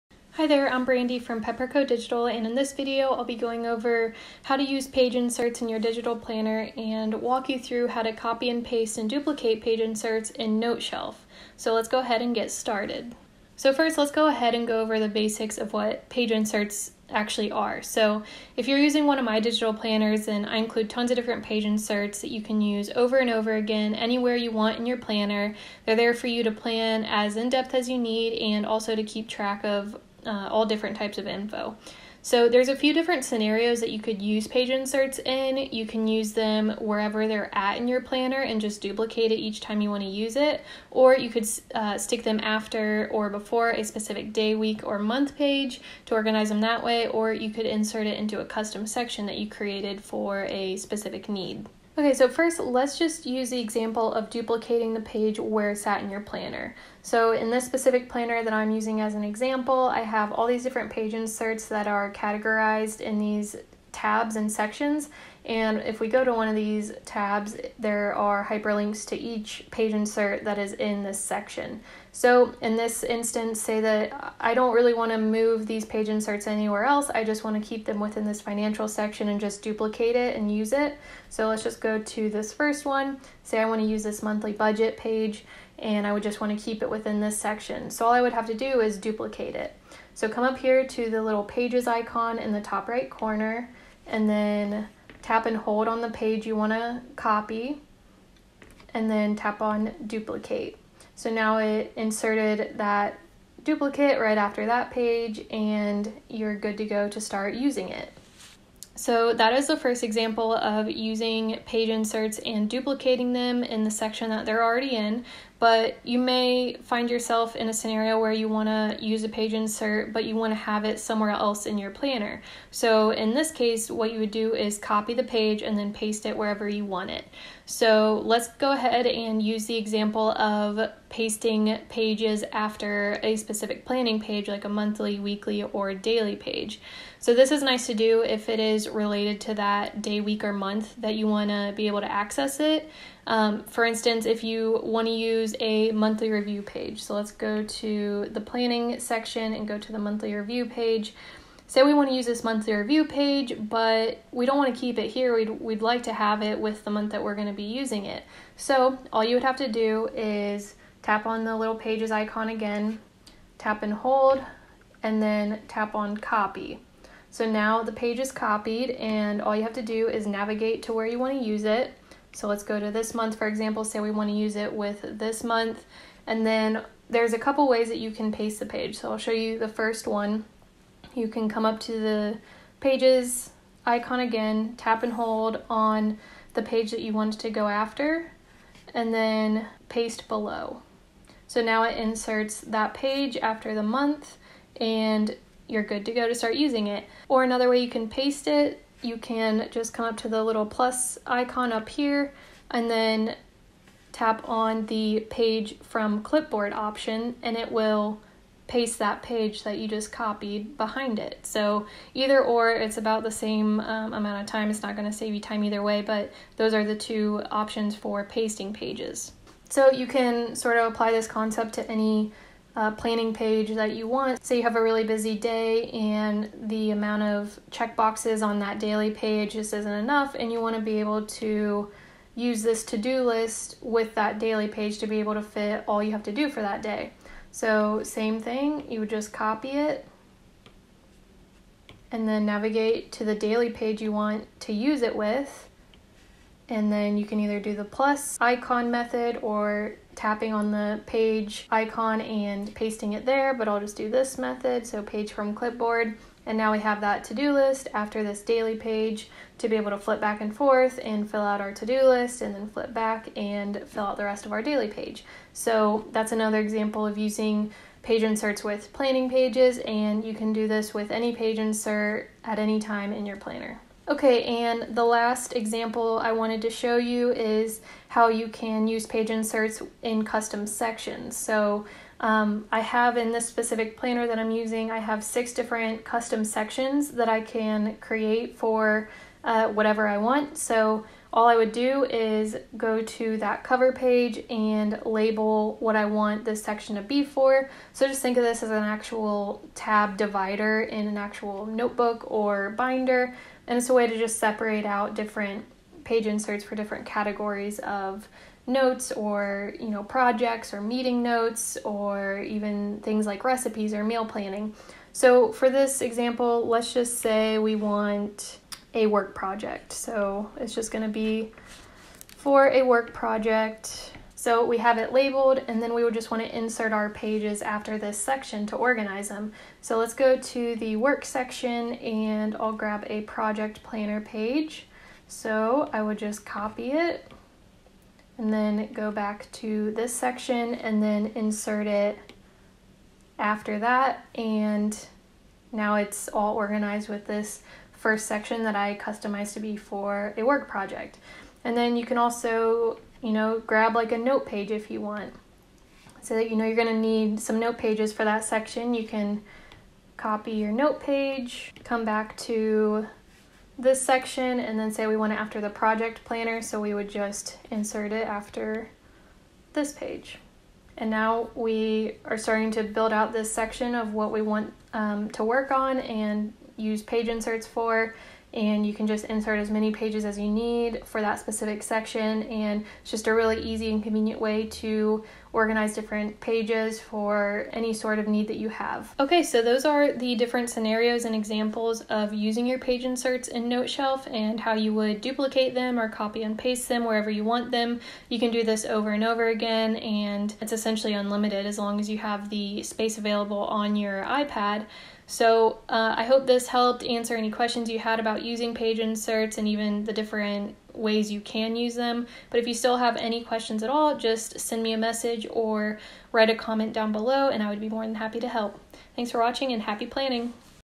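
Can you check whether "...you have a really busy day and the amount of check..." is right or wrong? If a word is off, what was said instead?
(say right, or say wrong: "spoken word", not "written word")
right.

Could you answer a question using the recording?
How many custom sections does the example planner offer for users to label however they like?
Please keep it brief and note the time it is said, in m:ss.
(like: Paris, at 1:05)
6, at 4:45.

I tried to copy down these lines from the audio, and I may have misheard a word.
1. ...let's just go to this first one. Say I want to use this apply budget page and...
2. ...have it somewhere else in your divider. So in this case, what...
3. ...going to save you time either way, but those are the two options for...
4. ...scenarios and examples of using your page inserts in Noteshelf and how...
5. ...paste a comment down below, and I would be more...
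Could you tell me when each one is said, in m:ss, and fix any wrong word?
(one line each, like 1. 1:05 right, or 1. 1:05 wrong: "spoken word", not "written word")
1. 1:21 wrong: "monthly", not "apply"
2. 2:00 wrong: "planner", not "divider"
3. 3:34 right
4. 6:30 right
5. 6:56 wrong: "write", not "paste".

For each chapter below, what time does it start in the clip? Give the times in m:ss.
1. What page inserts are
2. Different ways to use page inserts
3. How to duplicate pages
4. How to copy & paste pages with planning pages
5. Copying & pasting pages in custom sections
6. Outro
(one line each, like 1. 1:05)
1. 0:13
2. 0:33
3. 0:52
4. 1:56
5. 4:34
6. 6:30.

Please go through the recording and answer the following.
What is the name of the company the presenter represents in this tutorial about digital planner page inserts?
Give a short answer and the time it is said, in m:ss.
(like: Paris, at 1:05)
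Pepperko Digital, at 0:01.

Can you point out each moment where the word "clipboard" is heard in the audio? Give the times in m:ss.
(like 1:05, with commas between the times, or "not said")
3:26, 4:15.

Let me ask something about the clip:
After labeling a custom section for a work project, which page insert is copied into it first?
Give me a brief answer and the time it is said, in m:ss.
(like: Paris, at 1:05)
project planner page, at 5:33.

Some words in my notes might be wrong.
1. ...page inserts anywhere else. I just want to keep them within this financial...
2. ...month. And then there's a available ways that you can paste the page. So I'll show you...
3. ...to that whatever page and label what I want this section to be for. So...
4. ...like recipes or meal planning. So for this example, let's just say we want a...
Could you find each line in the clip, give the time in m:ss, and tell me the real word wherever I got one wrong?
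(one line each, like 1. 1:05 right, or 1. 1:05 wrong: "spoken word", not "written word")
1. 1:15 right
2. 2:55 wrong: "couple", not "available"
3. 4:53 wrong: "cover", not "whatever"
4. 5:13 right.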